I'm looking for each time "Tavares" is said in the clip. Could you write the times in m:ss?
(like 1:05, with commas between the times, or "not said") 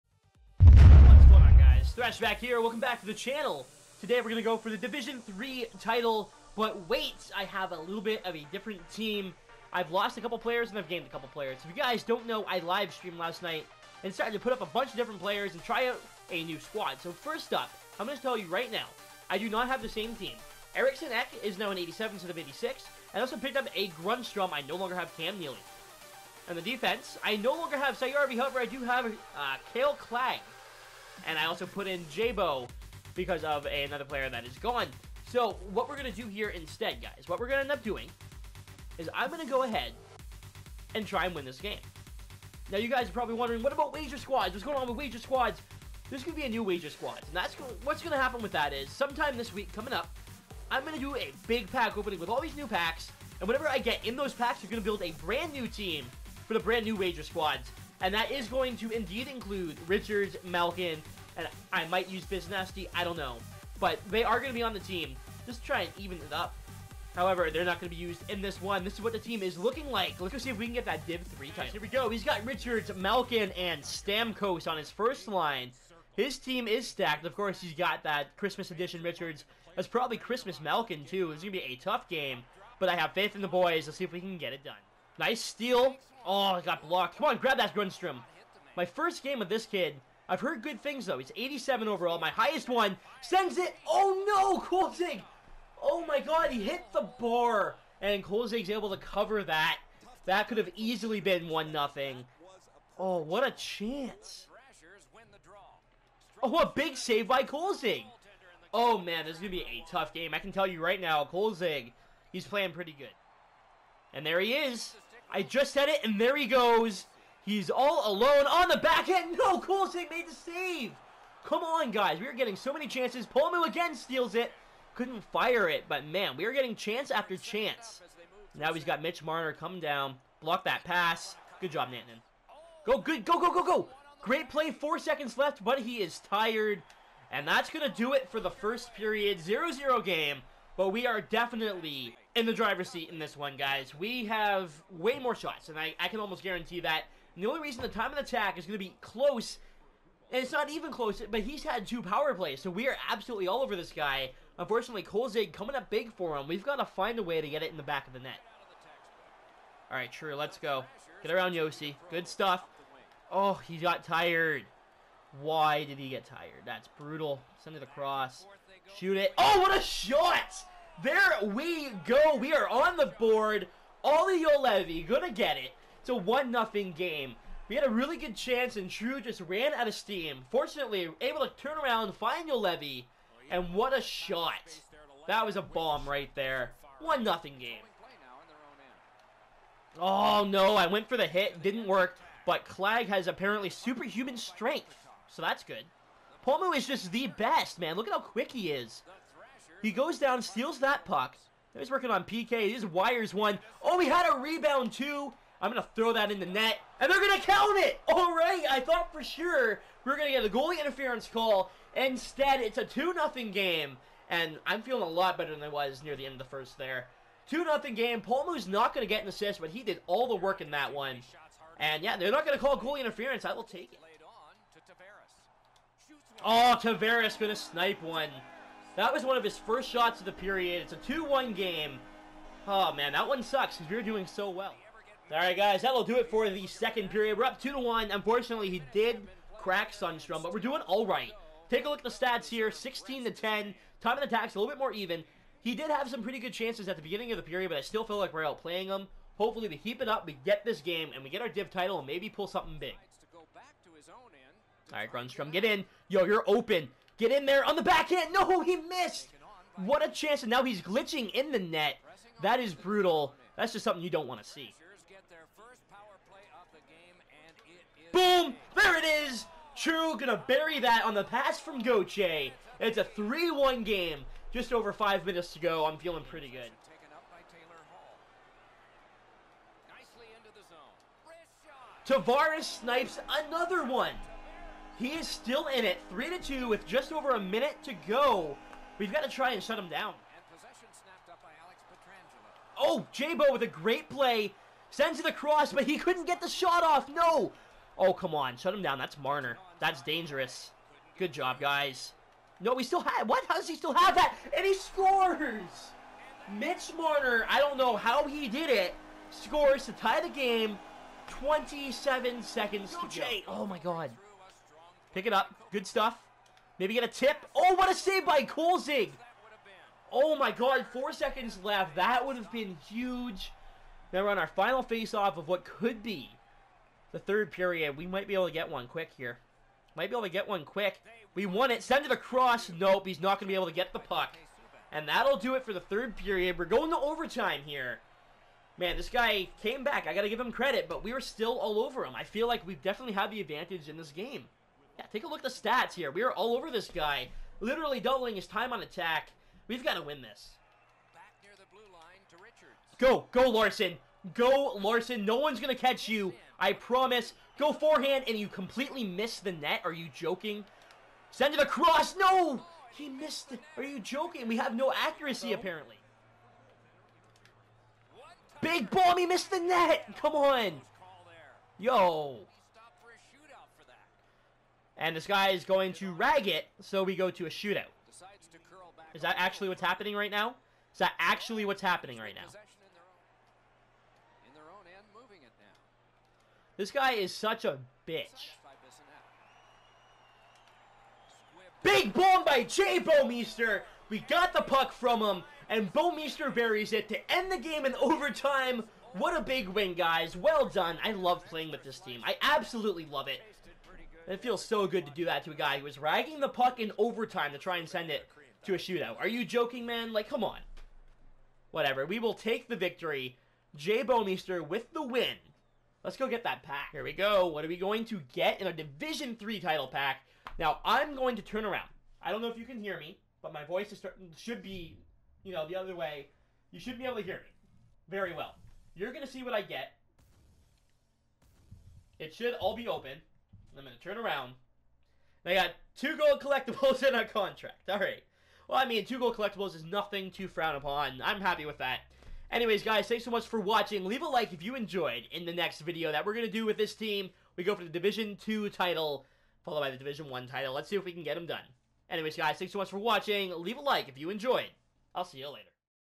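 3:46, 4:42.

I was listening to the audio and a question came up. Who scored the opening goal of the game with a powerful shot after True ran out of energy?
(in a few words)
Olli Juolevi.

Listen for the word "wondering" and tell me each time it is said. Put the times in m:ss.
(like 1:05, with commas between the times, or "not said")
0:43.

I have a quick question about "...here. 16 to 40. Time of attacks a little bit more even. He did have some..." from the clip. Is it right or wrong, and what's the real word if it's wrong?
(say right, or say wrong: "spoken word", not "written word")
wrong: "10", not "40".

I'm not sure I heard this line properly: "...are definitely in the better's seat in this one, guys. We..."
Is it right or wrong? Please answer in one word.
wrong.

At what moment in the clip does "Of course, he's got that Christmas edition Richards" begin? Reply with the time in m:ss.
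1:17.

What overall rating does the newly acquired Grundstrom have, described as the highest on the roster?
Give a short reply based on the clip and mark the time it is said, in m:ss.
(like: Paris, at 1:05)
87, at 1:31.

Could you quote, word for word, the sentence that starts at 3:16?
Palmu is just the best, man.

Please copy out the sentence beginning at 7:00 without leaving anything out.
Now, I'm going to turn around.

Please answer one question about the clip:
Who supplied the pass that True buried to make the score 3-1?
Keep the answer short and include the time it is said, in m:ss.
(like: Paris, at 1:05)
Goche, at 4:31.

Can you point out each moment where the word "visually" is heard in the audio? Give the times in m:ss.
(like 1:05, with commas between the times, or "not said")
not said.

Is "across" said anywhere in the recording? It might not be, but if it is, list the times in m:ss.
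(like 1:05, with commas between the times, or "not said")
2:47, 4:55, 5:32, 6:01.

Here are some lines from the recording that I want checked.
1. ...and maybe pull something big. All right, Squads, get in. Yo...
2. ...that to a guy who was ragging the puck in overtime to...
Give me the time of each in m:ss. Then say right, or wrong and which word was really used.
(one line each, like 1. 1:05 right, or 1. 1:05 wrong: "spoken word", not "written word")
1. 4:11 wrong: "Grundstrom", not "Squads"
2. 6:45 right.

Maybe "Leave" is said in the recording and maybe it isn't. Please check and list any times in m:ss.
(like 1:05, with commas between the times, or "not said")
7:24, 7:33.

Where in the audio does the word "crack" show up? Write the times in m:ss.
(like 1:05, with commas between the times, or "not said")
3:59.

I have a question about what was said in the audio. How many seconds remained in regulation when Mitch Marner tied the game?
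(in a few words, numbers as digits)
27.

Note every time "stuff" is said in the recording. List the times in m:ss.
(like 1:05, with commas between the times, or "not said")
2:42, 5:15.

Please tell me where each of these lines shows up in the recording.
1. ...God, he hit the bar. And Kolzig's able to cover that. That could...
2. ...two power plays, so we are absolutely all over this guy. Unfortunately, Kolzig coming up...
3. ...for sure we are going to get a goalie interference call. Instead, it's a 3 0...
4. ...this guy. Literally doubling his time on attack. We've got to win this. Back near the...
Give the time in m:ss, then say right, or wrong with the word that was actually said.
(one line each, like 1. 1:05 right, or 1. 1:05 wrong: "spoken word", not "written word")
1. 1:36 right
2. 2:31 right
3. 3:29 wrong: "2", not "3"
4. 5:46 right.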